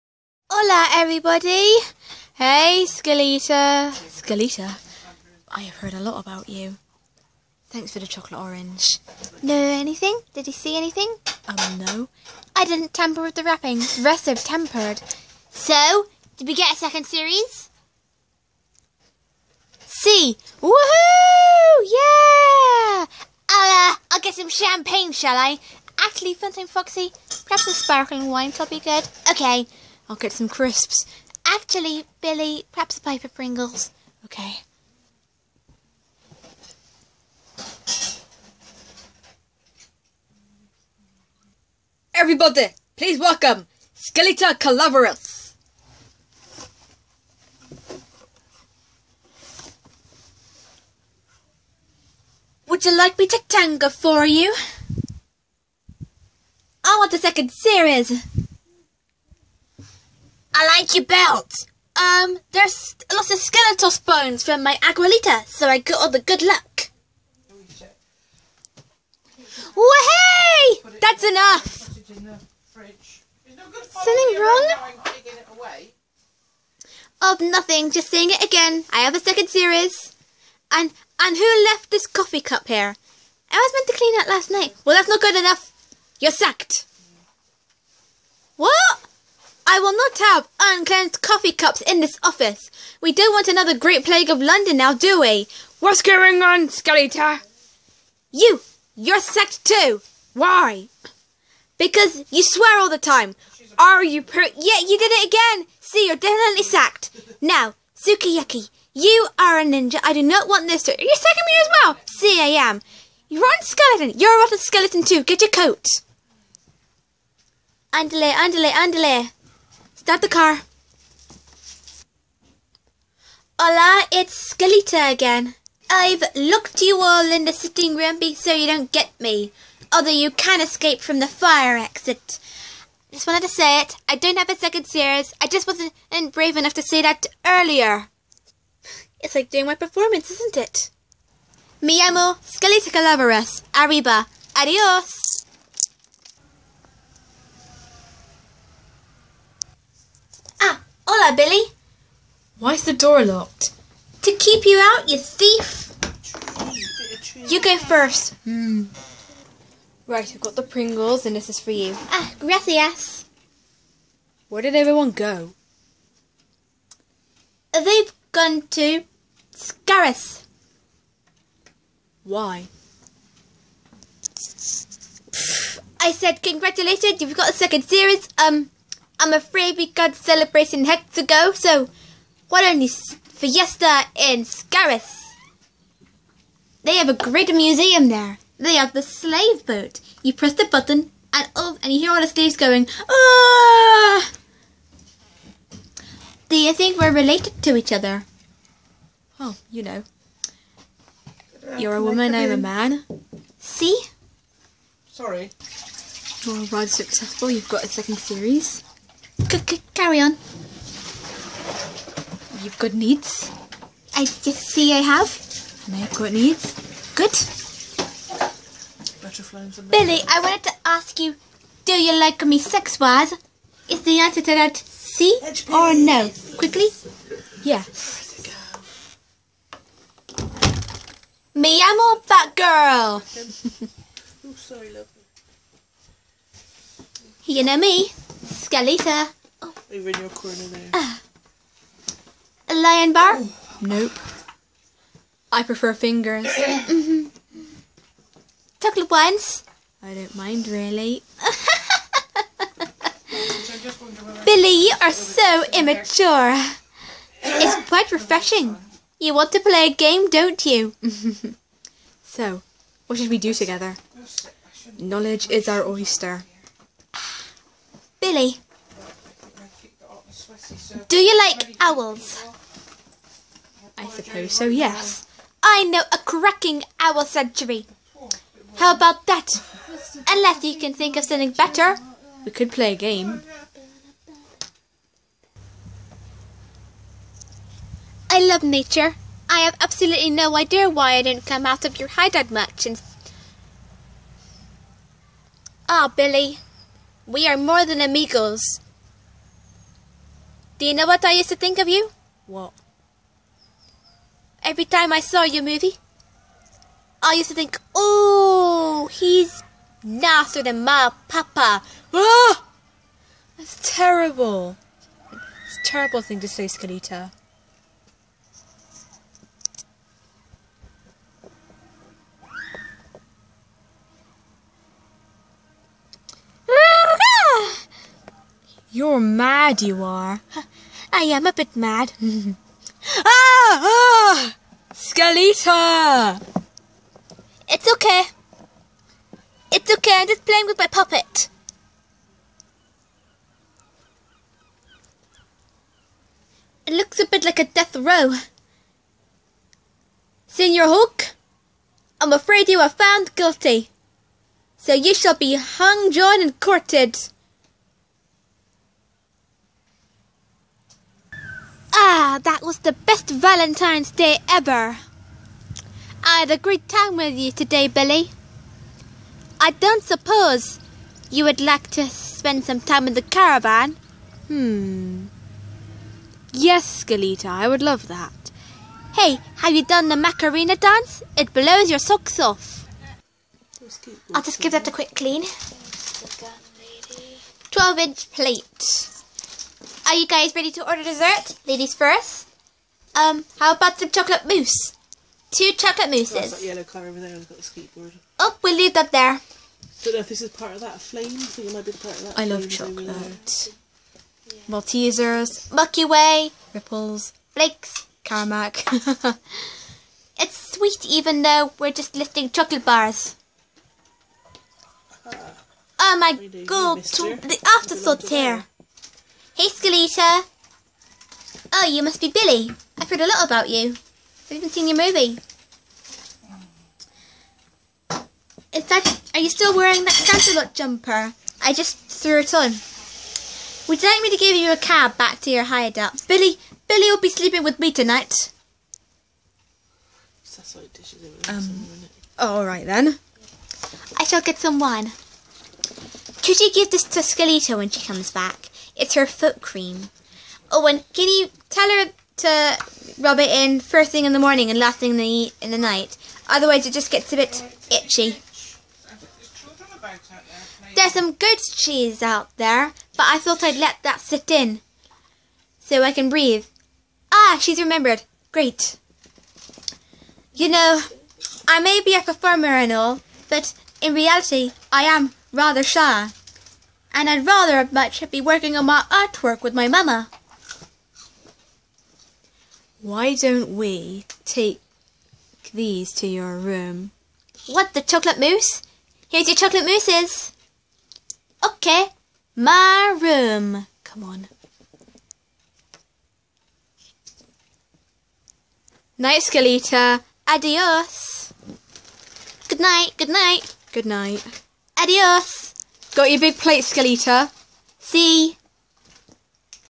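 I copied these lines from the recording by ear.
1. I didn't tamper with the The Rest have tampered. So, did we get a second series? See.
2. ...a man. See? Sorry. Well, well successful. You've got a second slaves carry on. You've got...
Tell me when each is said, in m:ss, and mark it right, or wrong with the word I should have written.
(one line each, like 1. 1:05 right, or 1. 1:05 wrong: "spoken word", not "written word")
1. 0:12 right
2. 3:22 wrong: "series", not "slaves".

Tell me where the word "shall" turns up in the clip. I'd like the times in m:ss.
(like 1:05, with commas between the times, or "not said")
0:25, 5:55, 7:24.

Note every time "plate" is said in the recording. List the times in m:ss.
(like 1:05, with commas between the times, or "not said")
6:28, 8:26.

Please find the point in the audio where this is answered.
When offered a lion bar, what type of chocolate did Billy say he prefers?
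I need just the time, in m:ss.
4:05.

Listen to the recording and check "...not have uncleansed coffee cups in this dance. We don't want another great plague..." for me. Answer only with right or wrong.
wrong.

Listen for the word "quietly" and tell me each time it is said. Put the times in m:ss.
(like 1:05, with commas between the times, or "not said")
not said.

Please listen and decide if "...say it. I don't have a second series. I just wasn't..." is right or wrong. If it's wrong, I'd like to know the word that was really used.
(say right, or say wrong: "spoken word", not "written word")
right.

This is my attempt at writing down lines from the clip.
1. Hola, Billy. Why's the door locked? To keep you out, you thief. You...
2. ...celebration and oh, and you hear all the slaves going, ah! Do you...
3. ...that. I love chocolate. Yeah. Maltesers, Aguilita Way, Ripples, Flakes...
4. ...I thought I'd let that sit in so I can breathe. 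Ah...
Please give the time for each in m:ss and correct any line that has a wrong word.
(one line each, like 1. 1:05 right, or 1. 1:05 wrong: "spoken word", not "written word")
1. 2:31 right
2. 3:10 wrong: "button", not "celebration"
3. 6:42 wrong: "Milky", not "Aguilita"
4. 7:43 right.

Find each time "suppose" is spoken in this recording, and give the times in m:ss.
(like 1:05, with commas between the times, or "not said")
4:34, 6:10.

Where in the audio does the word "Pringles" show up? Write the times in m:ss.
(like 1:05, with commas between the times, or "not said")
0:33, 2:40.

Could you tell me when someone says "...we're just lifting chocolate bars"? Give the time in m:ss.
6:51.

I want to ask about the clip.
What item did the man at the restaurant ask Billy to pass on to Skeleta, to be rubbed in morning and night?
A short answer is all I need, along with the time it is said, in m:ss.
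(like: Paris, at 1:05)
Foot cream, at 7:29.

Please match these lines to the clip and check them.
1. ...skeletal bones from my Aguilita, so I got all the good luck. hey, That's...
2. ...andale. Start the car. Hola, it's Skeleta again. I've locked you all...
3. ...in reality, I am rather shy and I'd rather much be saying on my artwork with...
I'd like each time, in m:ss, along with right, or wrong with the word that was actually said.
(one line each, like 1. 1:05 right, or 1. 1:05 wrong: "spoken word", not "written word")
1. 1:03 right
2. 1:58 right
3. 7:53 wrong: "working", not "saying".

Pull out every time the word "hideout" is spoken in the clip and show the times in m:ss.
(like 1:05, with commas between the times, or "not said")
4:52, 7:15.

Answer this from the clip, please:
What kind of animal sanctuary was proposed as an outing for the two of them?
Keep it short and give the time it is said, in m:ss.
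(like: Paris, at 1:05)
Owl sanctuary, at 4:36.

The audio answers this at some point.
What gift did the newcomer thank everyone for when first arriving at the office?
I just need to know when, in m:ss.
0:08.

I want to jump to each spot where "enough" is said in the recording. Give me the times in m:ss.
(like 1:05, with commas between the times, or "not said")
1:11, 1:25, 2:16.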